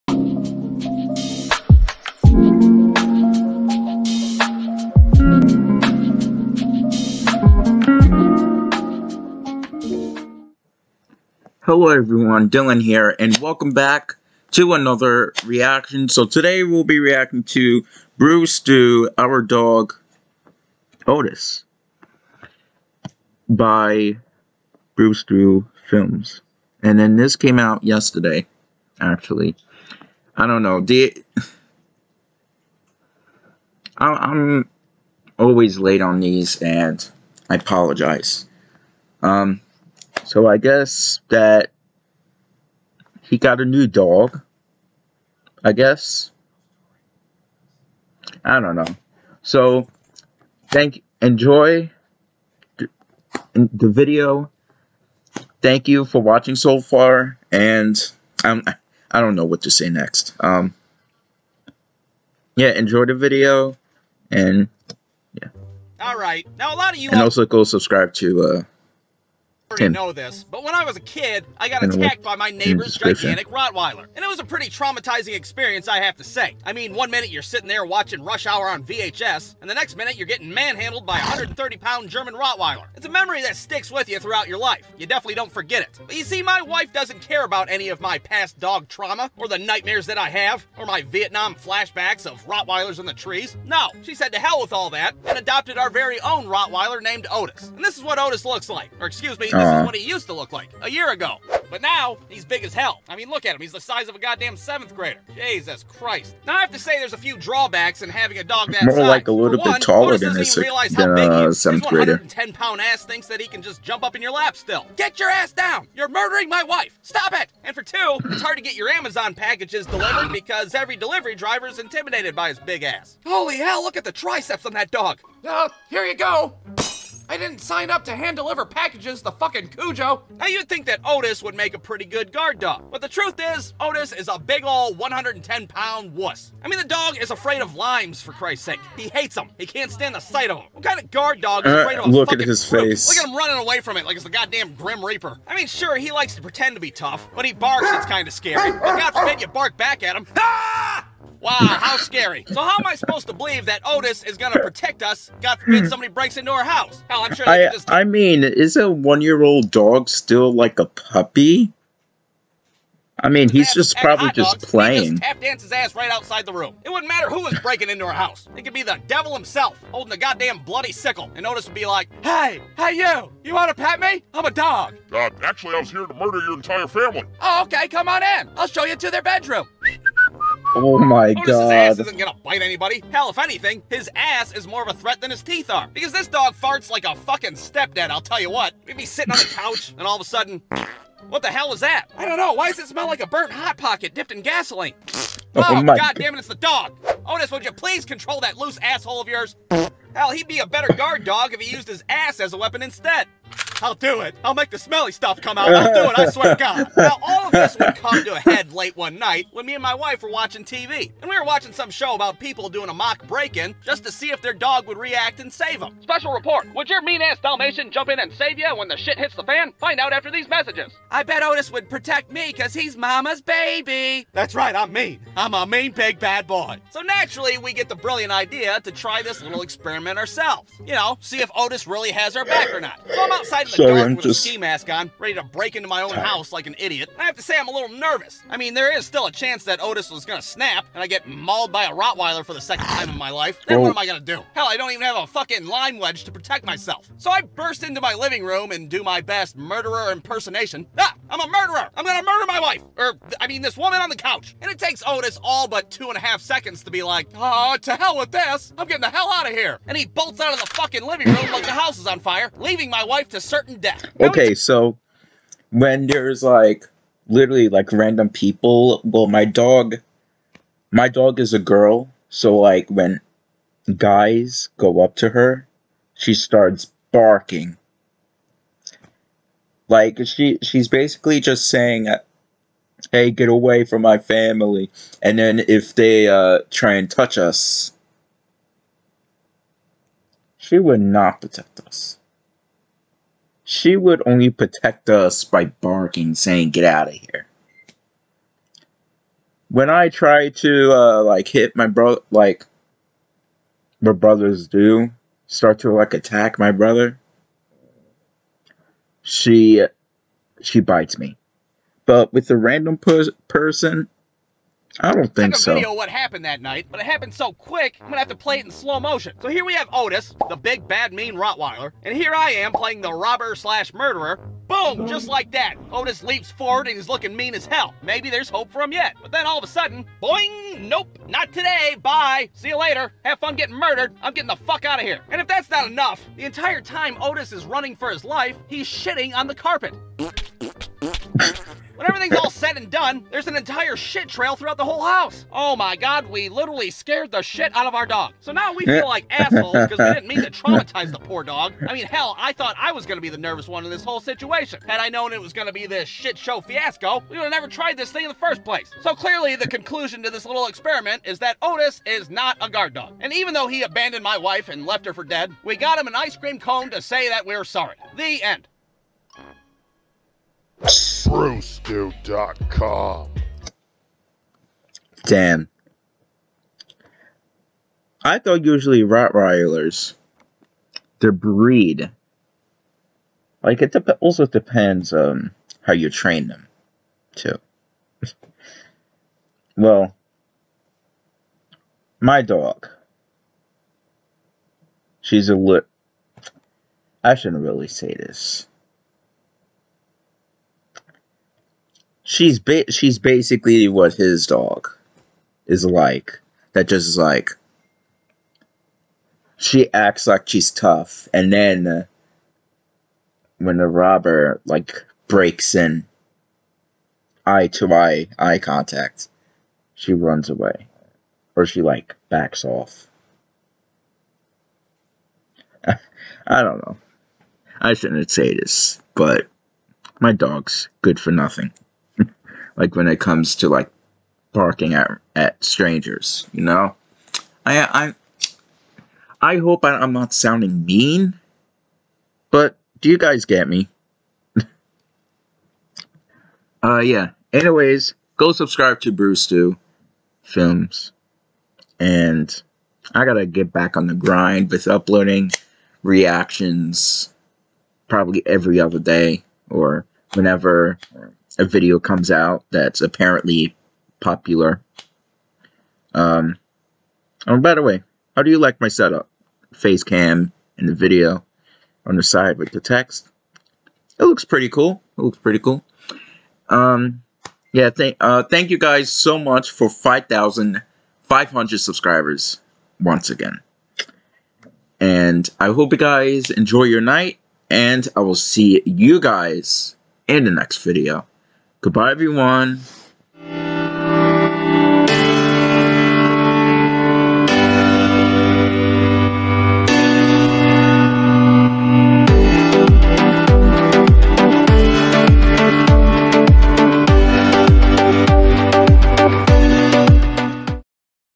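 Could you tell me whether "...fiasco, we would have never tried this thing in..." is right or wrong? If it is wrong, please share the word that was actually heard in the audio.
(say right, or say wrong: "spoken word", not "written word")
right.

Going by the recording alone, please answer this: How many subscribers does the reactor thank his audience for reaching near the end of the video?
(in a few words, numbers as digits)
5,500.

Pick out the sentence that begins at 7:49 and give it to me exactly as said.
Face cam and the video on the side with the text.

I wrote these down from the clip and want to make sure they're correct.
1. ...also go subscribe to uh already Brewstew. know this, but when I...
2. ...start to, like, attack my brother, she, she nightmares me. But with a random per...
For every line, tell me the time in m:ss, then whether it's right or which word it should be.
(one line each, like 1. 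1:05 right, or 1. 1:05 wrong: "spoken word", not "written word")
1. 1:07 wrong: "Tim", not "Brewstew"
2. 5:05 wrong: "bites", not "nightmares".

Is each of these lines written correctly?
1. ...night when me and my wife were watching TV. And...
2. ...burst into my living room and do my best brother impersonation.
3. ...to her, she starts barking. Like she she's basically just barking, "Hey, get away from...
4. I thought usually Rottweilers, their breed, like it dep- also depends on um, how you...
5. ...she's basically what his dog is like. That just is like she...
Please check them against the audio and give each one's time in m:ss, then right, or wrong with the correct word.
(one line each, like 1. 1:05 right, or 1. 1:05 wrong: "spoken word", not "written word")
1. 3:29 right
2. 4:07 wrong: "murderer", not "brother"
3. 4:35 wrong: "saying", not "barking"
4. 6:18 right
5. 6:42 right.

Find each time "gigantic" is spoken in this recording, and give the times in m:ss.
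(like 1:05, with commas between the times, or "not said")
1:12.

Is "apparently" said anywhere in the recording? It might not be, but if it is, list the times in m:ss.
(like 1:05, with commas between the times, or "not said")
7:43.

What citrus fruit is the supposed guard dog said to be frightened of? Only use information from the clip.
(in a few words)
Limes.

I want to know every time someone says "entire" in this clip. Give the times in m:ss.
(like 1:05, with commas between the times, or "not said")
2:56, 5:36, 5:43.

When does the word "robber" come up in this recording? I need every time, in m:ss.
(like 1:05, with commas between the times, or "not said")
5:23, 6:53.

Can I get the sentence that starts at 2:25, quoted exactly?
I mean, sure, he likes to pretend to be tough, but he barks, it's kind of scary.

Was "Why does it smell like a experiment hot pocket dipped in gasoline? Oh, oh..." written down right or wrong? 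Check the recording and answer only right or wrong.
wrong.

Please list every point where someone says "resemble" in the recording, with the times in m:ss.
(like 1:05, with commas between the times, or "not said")
not said.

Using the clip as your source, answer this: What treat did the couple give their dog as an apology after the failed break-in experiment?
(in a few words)
An ice cream cone.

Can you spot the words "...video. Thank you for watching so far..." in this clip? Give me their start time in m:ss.
0:53.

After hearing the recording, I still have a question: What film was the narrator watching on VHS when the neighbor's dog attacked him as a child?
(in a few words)
Rush Hour.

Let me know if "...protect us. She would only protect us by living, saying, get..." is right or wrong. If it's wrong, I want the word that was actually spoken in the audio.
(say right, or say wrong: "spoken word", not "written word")
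wrong: "barking", not "living".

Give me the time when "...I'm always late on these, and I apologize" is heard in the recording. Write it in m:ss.
0:33.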